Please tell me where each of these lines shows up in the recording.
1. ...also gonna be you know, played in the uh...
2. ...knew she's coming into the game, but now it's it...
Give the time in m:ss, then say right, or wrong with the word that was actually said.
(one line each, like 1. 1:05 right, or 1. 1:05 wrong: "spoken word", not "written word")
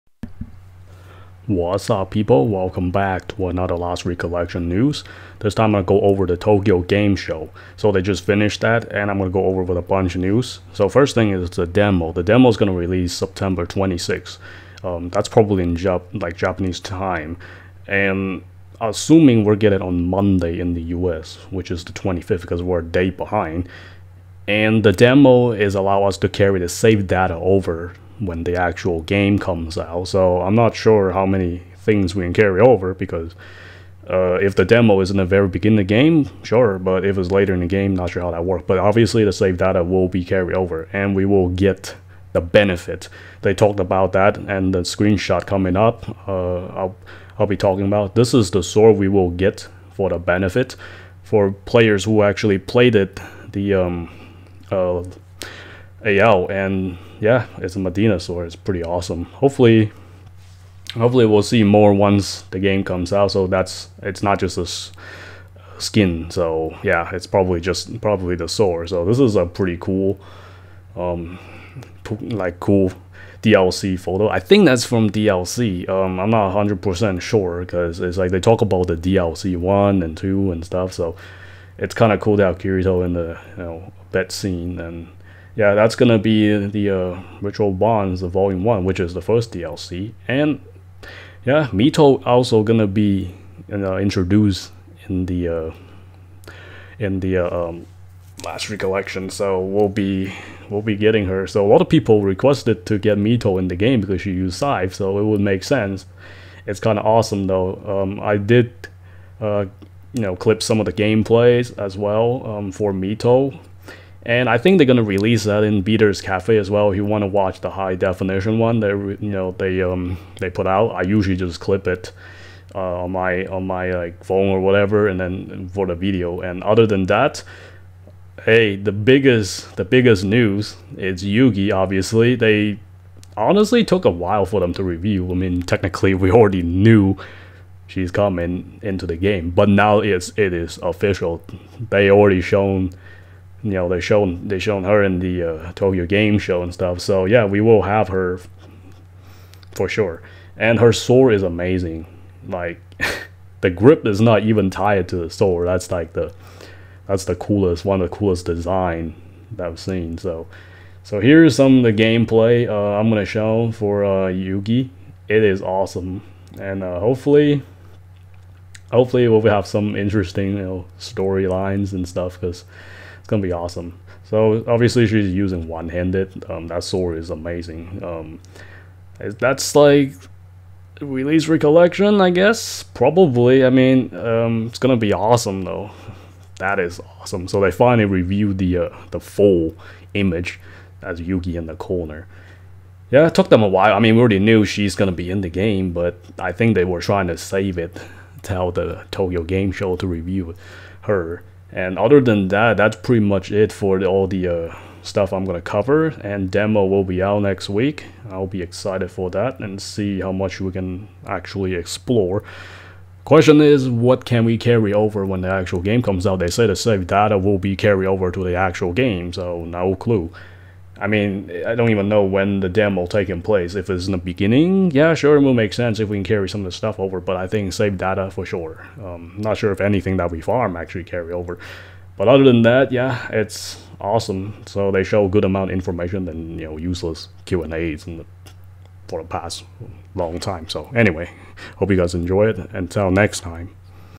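1. 1:32 wrong: "introduced", not "played"
2. 2:16 right.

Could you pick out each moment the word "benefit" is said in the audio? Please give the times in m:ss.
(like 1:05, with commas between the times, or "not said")
0:42, 0:50.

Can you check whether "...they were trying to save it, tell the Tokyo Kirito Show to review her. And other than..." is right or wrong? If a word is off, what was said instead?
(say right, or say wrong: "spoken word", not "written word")
wrong: "Game", not "Kirito".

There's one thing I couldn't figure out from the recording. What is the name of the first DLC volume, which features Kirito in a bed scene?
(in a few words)
Ritual Bonds.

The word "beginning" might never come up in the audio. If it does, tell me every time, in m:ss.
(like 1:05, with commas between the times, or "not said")
0:35, 3:44.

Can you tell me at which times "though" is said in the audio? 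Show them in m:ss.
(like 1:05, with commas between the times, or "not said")
1:47, 3:05.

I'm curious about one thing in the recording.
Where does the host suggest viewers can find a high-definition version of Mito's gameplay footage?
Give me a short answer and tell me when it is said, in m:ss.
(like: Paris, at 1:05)
Beater's Cafe, at 1:55.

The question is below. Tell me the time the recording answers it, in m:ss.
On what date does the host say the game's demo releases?
0:13.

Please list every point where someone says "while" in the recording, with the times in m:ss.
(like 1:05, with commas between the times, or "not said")
2:14, 3:13.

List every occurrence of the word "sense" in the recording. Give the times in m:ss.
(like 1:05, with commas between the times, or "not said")
1:45, 3:45.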